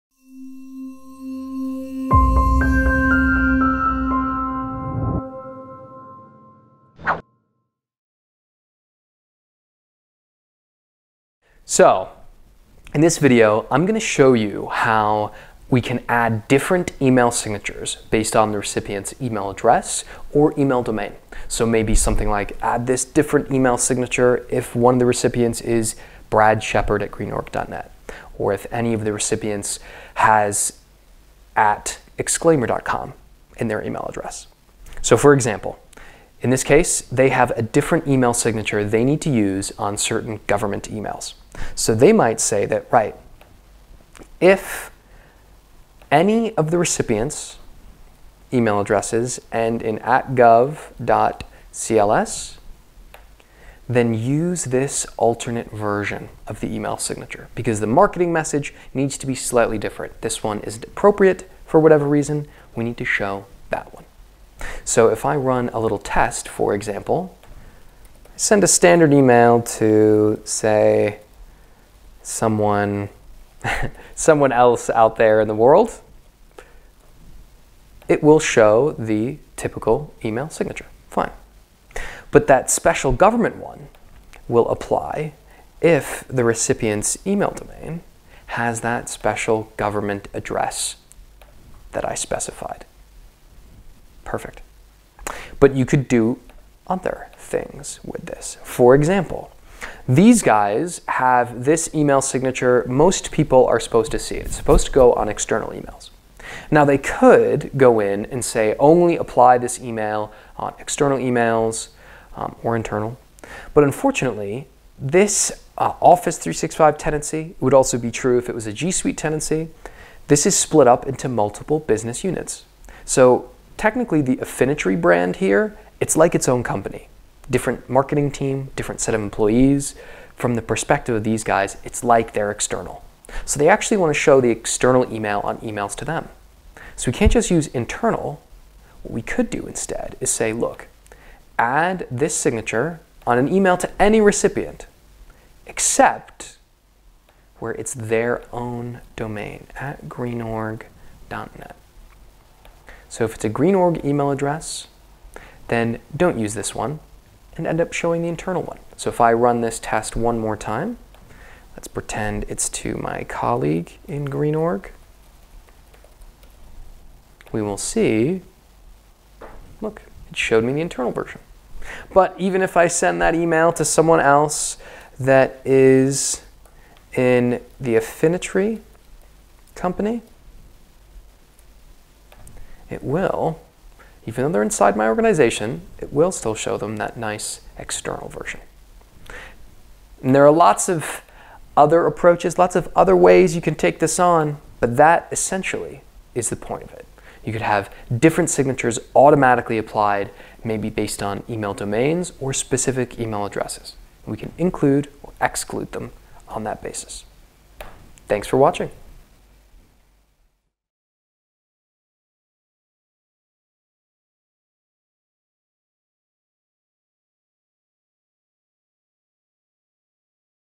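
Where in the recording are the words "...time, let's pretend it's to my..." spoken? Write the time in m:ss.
2:40.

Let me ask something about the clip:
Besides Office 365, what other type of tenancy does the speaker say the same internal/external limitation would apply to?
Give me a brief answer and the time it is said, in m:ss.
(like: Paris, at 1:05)
G Suite, at 1:58.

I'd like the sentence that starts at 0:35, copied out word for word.
So for example, in this case, they have a different email signature they need to use on certain government emails.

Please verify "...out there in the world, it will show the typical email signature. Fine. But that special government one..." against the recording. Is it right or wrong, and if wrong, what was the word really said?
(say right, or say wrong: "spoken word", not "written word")
right.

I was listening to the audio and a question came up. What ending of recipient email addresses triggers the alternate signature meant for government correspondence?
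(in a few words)
gov.cls.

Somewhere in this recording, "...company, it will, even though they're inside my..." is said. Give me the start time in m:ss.
2:59.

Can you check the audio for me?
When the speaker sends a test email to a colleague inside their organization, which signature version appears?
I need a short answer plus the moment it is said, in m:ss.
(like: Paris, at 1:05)
internal version, at 2:50.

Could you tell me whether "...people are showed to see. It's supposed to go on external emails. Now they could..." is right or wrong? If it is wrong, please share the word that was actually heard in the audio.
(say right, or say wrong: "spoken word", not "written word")
wrong: "supposed", not "showed".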